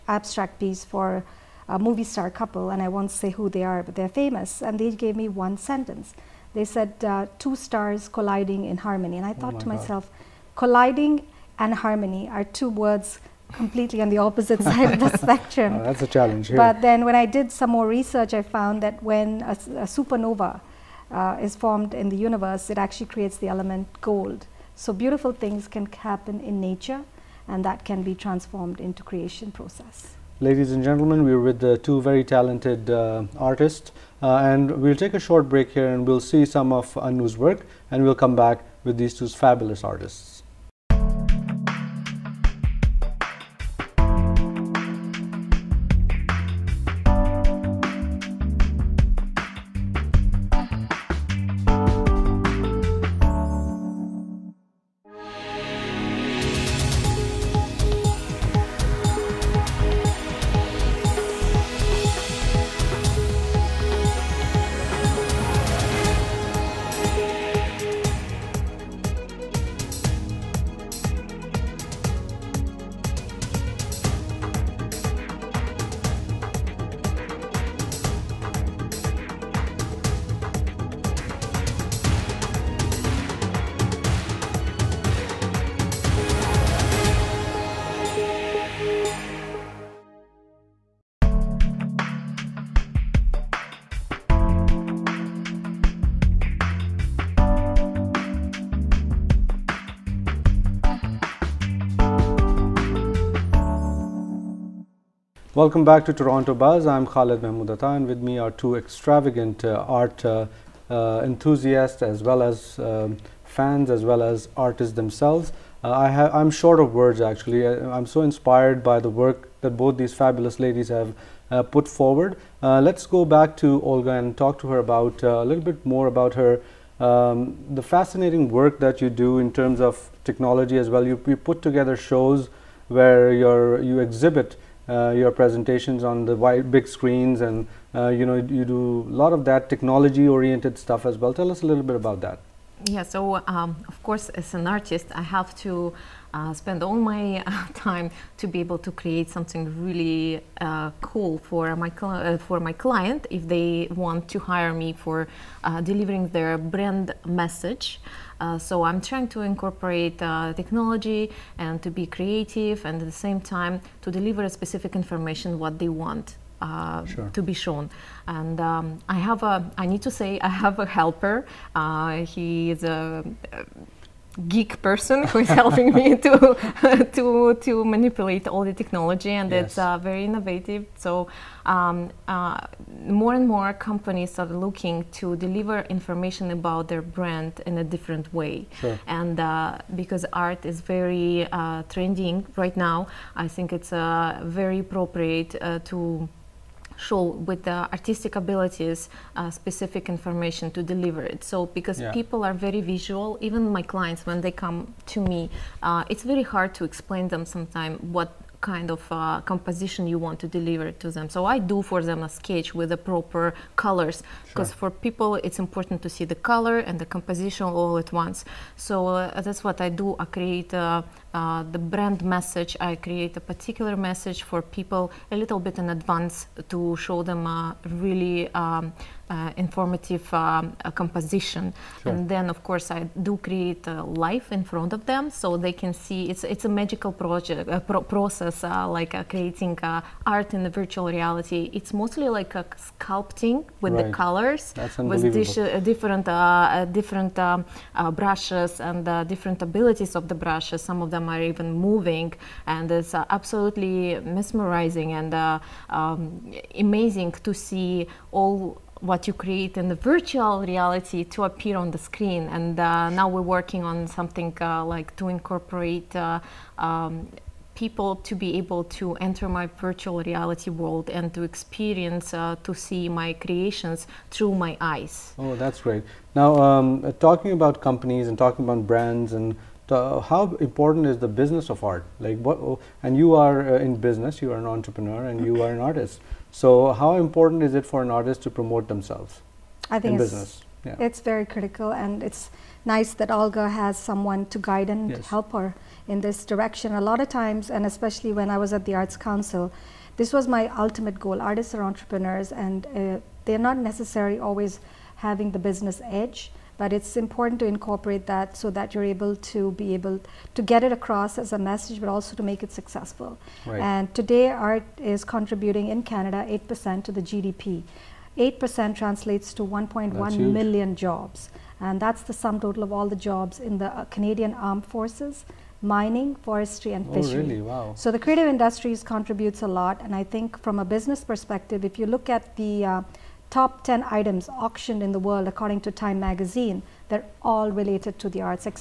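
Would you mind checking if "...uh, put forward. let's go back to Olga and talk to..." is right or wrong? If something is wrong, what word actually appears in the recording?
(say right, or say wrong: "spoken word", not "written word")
right.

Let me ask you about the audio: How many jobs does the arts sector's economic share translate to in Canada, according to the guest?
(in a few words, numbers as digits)
1.1 million.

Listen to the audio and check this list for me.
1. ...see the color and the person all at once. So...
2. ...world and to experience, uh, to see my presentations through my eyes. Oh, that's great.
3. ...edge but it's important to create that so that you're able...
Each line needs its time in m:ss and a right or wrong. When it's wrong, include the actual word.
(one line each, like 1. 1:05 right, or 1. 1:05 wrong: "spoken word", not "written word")
1. 3:36 wrong: "composition", not "person"
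2. 4:30 wrong: "creations", not "presentations"
3. 5:06 wrong: "incorporate", not "create".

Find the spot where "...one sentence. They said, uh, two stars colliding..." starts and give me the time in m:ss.
0:05.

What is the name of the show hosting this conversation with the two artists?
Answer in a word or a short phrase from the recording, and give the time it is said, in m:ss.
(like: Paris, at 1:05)
Toronto Buzz, at 1:46.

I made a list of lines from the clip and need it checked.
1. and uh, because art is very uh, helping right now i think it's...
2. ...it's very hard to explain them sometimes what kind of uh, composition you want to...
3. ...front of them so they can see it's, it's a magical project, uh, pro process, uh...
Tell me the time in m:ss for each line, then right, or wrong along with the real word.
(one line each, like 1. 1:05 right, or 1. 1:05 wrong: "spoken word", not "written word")
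1. 3:09 wrong: "trending", not "helping"
2. 3:26 right
3. 3:54 right.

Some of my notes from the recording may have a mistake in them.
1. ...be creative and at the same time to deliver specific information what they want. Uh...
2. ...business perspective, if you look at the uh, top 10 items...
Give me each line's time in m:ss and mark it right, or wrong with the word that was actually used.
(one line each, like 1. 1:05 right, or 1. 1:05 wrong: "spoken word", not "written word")
1. 2:41 right
2. 5:30 right.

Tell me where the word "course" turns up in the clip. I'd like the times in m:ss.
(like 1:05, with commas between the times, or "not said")
2:24, 3:52.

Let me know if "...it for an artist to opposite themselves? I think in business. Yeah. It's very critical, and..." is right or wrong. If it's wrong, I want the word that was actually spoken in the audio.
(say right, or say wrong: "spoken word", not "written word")
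wrong: "promote", not "opposite".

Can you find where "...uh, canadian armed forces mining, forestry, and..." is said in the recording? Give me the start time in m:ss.
5:24.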